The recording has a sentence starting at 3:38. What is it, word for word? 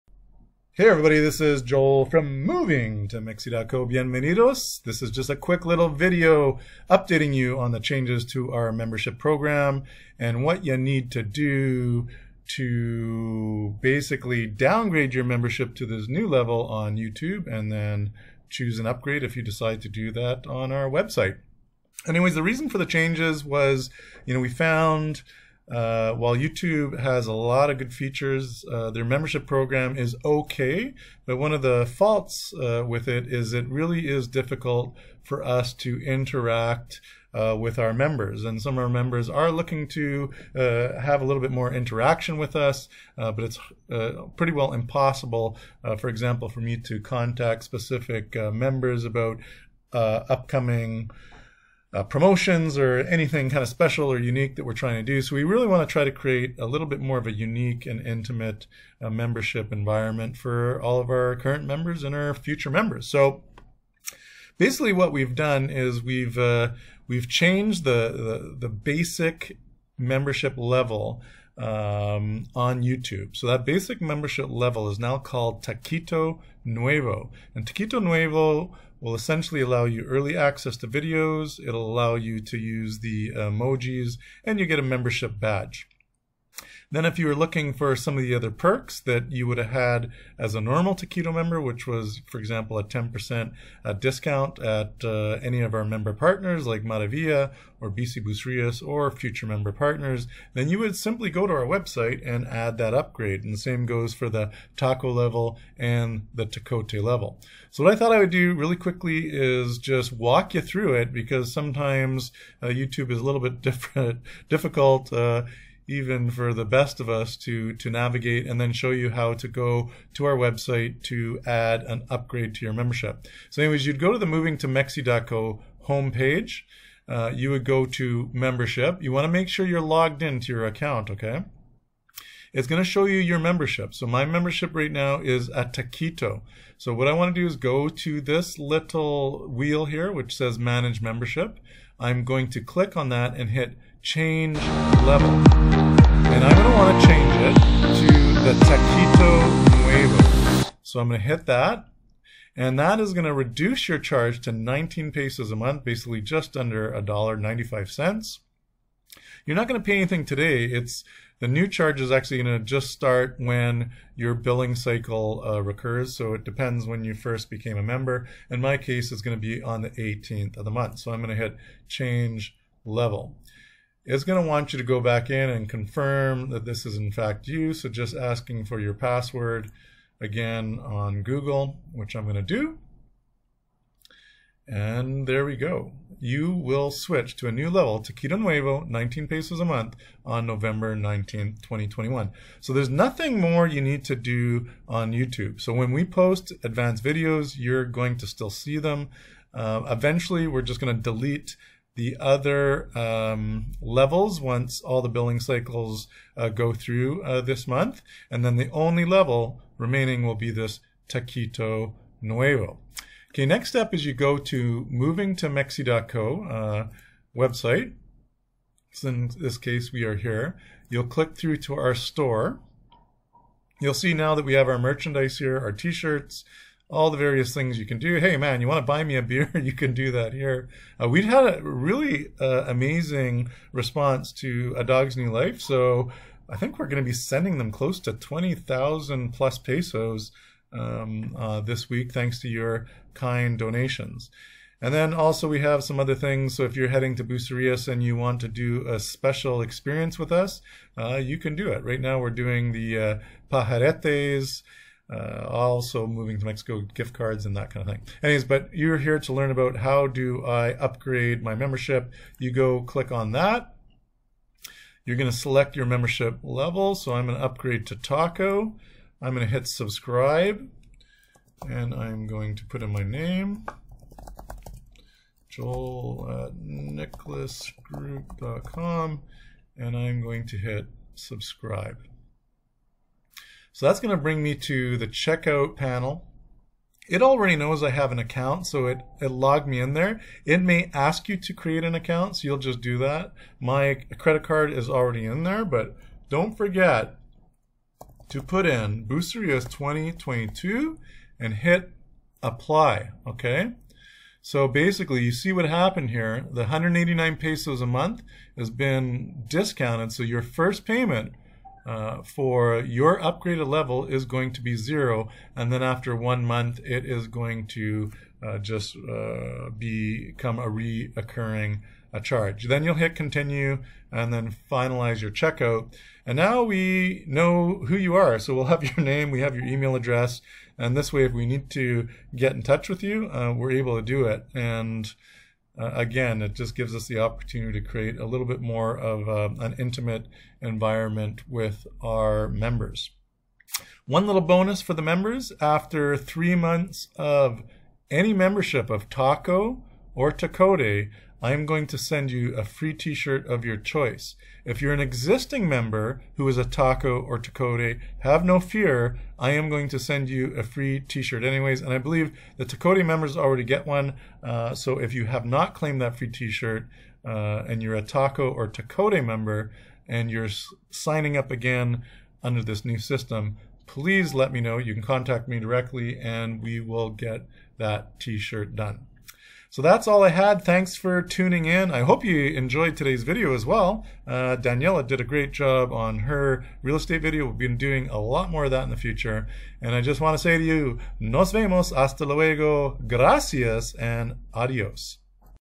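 So in this case, we are here.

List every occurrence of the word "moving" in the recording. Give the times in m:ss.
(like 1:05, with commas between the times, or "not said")
0:02, 2:04, 3:34, 4:16.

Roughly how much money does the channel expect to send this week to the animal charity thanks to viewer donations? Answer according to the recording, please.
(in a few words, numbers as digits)
20,000 pesos.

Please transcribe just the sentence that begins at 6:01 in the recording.
And I believe the Tacote members already get one.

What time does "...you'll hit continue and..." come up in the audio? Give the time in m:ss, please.
5:22.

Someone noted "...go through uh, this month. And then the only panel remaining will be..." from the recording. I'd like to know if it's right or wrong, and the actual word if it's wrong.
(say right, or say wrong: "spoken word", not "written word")
wrong: "level", not "panel".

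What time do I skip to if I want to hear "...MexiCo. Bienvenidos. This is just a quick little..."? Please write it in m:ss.
0:03.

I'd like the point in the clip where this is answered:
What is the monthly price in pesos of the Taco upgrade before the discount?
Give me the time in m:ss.
5:06.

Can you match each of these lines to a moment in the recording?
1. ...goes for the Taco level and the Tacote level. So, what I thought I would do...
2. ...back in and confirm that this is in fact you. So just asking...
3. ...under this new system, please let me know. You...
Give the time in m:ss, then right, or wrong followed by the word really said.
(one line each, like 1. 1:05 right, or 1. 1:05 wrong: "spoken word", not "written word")
1. 1:43 right
2. 2:54 right
3. 6:12 right.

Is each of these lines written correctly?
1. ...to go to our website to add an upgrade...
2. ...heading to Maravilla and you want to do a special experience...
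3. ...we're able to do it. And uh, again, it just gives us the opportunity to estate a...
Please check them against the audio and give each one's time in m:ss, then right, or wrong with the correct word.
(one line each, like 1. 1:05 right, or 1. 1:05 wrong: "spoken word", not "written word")
1. 1:59 right
2. 4:06 wrong: "Bucerias", not "Maravilla"
3. 5:33 wrong: "create", not "estate".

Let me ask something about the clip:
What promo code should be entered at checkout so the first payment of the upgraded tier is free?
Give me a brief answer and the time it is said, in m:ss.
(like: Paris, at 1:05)
Bucerias 2022, at 4:59.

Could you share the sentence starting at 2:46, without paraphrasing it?
So it depends when you first became a member.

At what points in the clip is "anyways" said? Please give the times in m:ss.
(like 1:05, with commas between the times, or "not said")
0:22, 2:03, 4:18, 6:01.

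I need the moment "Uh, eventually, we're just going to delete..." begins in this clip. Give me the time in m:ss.
3:19.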